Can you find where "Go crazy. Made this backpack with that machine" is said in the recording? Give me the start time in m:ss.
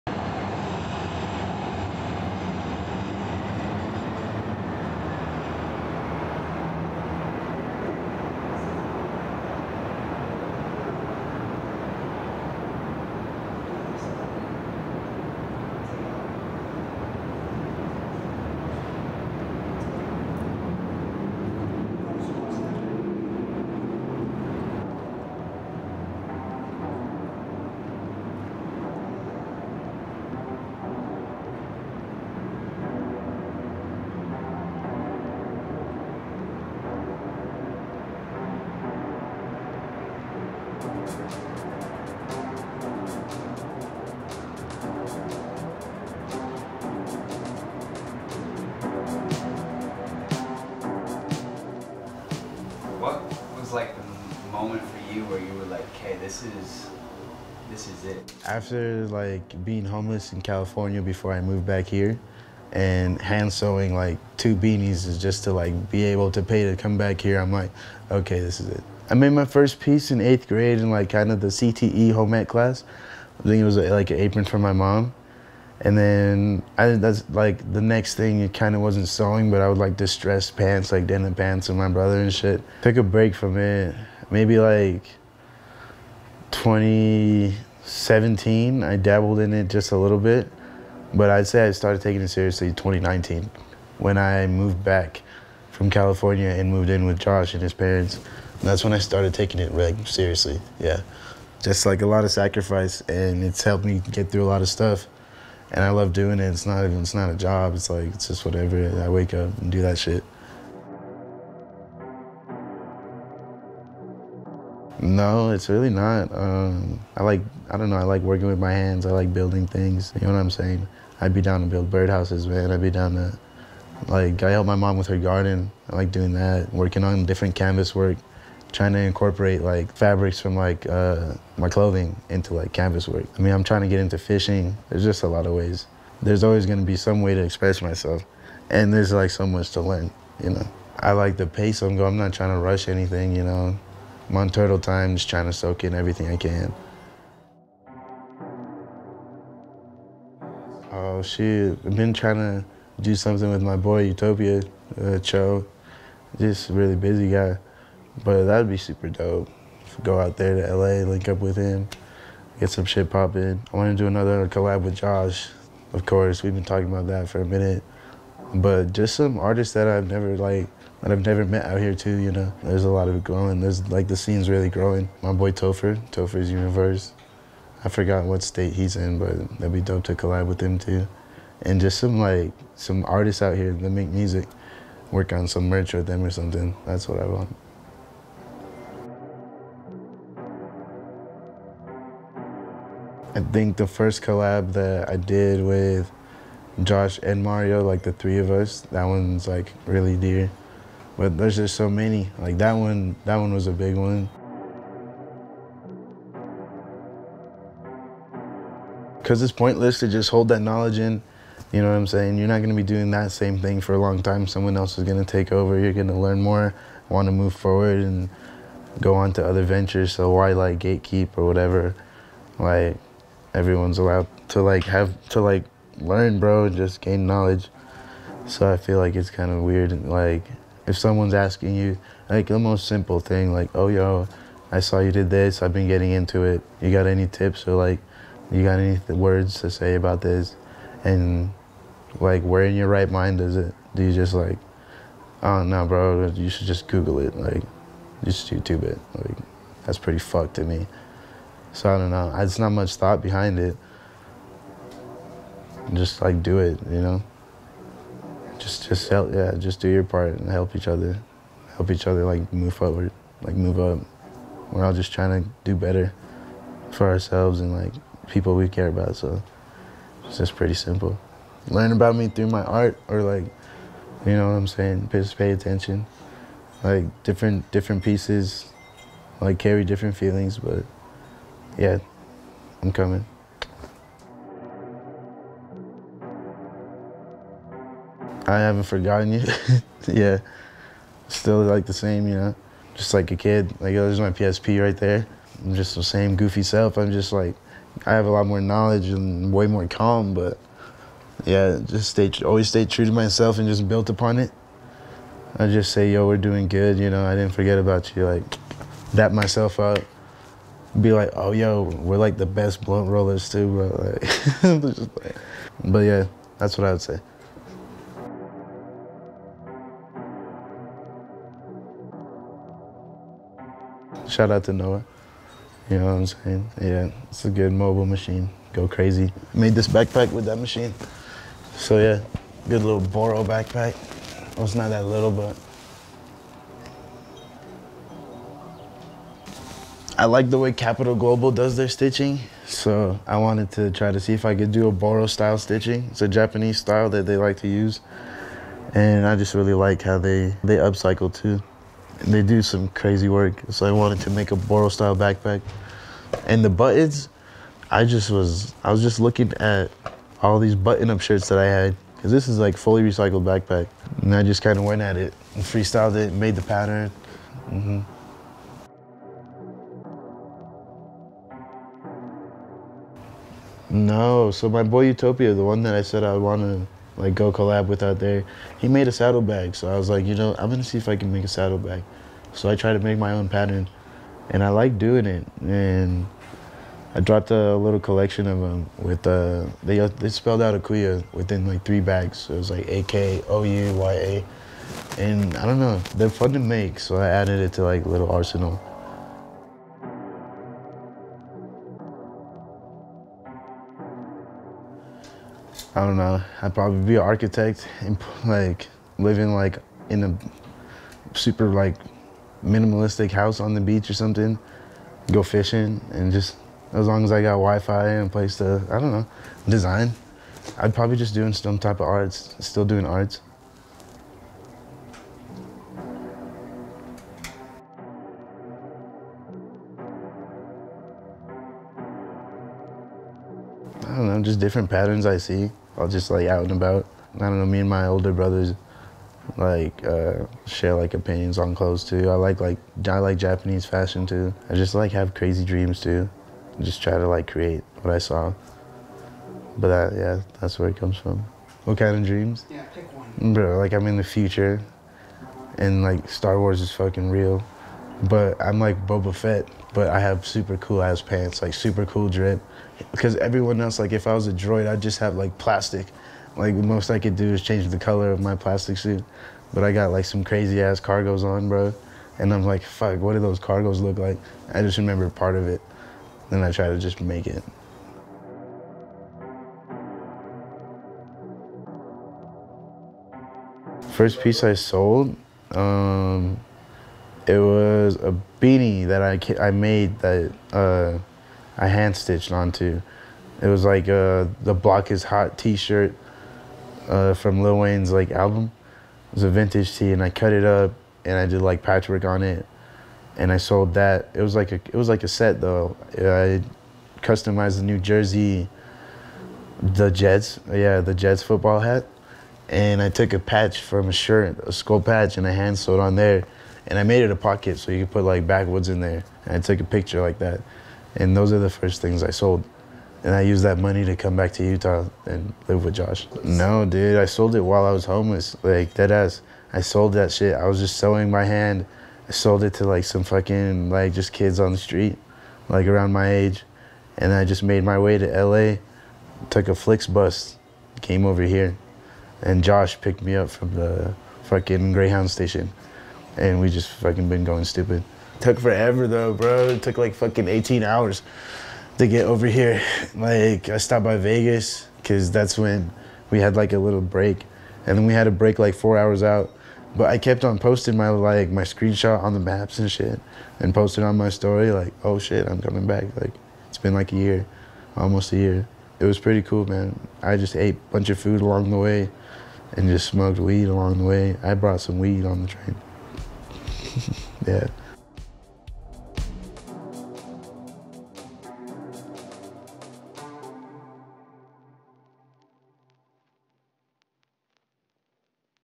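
5:28.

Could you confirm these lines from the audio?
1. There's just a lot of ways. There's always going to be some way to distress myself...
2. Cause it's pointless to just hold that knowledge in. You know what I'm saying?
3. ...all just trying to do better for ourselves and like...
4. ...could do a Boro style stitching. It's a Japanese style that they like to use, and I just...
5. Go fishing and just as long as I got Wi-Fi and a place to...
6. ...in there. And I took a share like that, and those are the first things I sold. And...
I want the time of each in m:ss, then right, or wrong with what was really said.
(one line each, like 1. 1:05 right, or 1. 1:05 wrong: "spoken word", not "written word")
1. 2:14 wrong: "express", not "distress"
2. 3:29 right
3. 4:24 right
4. 5:44 right
5. 6:55 right
6. 8:38 wrong: "picture", not "share".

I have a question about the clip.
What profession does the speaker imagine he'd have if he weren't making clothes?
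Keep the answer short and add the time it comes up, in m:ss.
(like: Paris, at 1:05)
Architect, at 6:47.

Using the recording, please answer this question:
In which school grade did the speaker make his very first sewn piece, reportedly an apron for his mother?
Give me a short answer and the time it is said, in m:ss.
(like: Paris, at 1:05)
8th grade, at 1:10.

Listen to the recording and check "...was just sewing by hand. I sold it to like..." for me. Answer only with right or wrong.
right.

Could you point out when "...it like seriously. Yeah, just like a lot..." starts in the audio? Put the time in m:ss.
1:39.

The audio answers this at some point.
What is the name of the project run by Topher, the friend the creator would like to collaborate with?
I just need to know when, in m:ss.
2:56.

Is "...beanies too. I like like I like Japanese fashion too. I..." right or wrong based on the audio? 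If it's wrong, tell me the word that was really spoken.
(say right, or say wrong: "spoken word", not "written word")
wrong: "clothes", not "beanies".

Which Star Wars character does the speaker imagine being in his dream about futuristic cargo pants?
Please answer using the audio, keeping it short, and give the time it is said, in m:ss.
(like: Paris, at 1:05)
Boba Fett, at 7:39.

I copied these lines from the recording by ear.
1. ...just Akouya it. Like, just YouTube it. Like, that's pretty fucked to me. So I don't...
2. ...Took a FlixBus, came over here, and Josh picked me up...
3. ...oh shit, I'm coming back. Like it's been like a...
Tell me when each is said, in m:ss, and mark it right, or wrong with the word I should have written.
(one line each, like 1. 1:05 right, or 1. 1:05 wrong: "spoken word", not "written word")
1. 4:06 wrong: "Google", not "Akouya"
2. 8:59 right
3. 9:25 right.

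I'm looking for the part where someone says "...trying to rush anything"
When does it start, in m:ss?
2:22.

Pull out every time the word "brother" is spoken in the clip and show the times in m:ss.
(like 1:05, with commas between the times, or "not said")
1:21, 7:18.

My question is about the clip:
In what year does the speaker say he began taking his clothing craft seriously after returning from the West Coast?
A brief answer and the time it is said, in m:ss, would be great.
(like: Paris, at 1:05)
2019, at 1:32.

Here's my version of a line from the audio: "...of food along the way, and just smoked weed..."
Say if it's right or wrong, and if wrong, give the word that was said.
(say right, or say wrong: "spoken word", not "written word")
right.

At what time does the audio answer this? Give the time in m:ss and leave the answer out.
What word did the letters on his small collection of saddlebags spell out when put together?
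6:30.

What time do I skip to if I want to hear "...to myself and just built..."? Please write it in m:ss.
5:03.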